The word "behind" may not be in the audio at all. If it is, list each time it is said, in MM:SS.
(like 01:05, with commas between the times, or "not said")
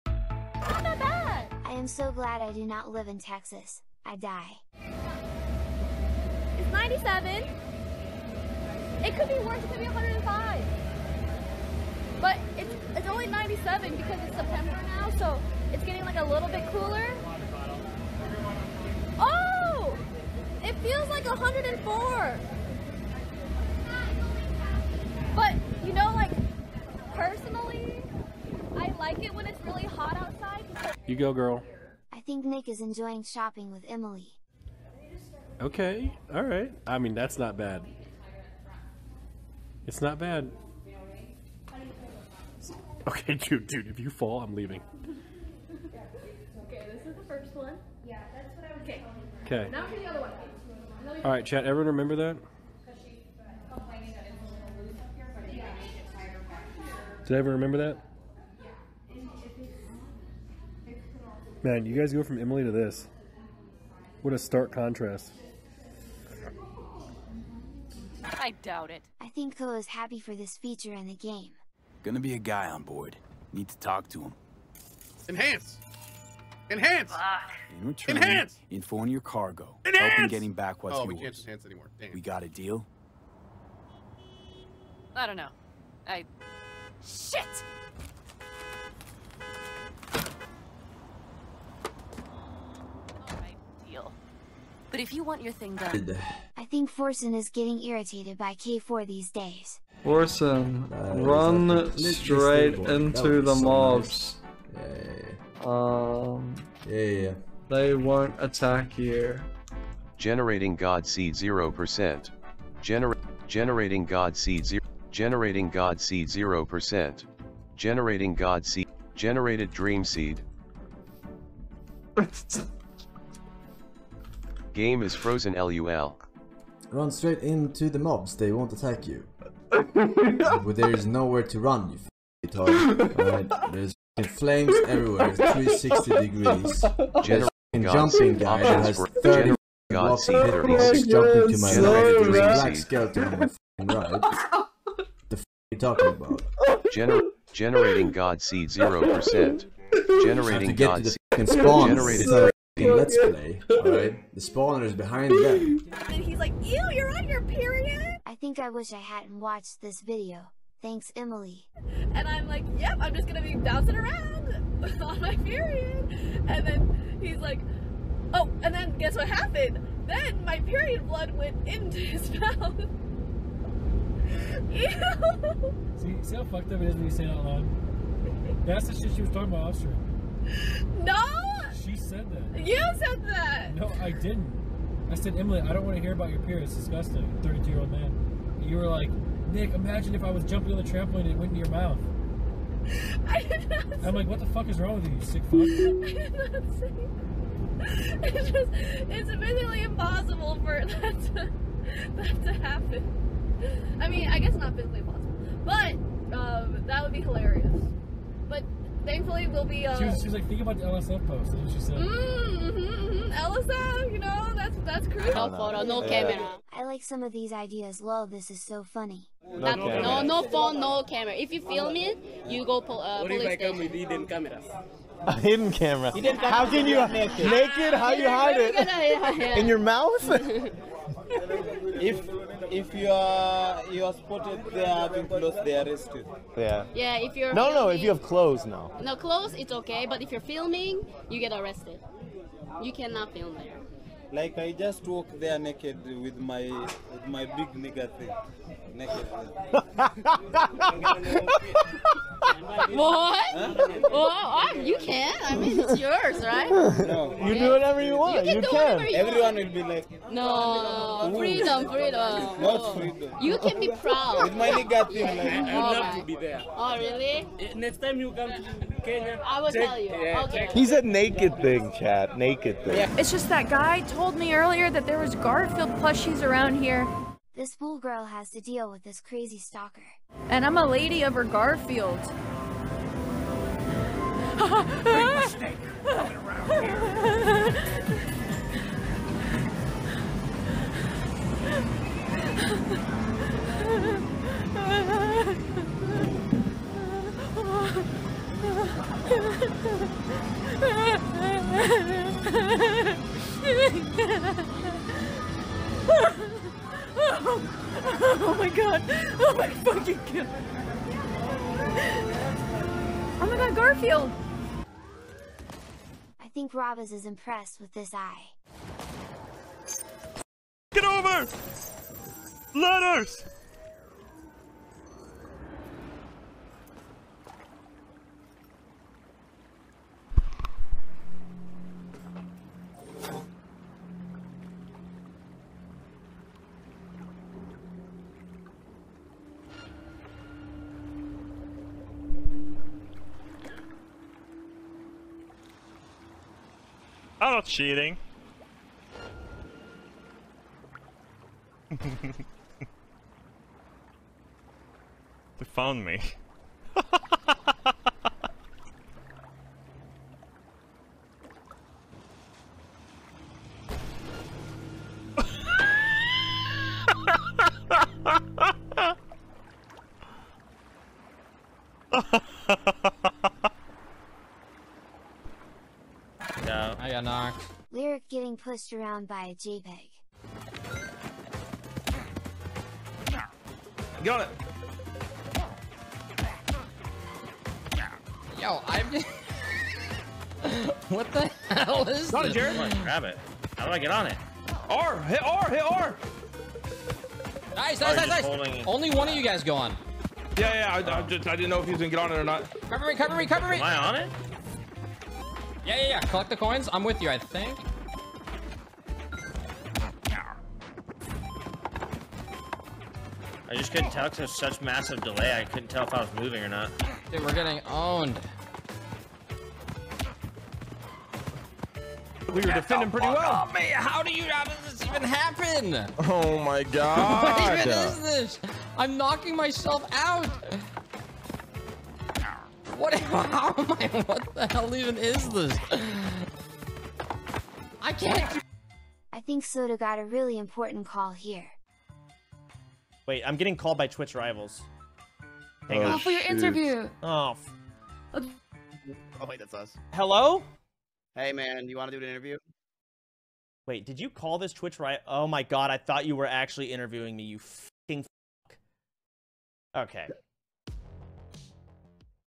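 02:34.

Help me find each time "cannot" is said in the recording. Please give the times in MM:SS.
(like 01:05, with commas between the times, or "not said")
04:02.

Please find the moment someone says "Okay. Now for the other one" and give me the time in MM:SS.
00:49.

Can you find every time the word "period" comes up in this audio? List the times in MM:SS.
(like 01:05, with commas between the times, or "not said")
02:37, 02:45, 02:50.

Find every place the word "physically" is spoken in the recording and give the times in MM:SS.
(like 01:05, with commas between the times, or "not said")
03:19, 03:24.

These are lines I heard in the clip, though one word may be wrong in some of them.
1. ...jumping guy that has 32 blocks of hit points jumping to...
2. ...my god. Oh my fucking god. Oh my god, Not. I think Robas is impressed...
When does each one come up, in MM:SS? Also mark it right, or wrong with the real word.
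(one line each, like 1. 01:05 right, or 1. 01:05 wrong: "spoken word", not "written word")
1. 02:17 wrong: "30", not "32"
2. 05:08 wrong: "Garfield", not "Not".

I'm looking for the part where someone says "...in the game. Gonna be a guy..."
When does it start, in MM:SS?
01:10.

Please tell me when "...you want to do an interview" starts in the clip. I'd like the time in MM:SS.
07:31.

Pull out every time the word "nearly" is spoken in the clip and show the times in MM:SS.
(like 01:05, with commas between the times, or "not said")
not said.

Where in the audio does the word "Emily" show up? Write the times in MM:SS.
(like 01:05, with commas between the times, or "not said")
00:33, 01:02, 02:41, 03:05.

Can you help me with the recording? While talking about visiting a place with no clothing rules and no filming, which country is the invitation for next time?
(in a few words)
Kenya.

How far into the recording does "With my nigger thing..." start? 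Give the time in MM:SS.
04:24.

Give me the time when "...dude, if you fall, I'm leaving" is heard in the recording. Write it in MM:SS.
00:43.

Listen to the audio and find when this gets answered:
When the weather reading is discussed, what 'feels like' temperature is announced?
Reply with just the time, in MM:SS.
00:20.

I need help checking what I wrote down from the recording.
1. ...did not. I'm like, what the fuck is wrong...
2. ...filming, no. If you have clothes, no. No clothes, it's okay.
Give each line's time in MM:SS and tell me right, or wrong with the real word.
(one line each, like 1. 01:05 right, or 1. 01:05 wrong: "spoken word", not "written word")
1. 03:13 right
2. 03:57 right.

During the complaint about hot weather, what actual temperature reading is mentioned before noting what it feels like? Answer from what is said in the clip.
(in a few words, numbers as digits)
97.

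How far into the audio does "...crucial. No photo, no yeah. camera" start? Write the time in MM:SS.
03:35.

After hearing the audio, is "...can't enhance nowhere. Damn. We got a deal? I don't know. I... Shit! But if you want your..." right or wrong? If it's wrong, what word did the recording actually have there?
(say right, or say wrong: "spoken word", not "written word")
wrong: "anymore", not "nowhere".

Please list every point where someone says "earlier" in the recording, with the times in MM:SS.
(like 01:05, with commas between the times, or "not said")
04:34.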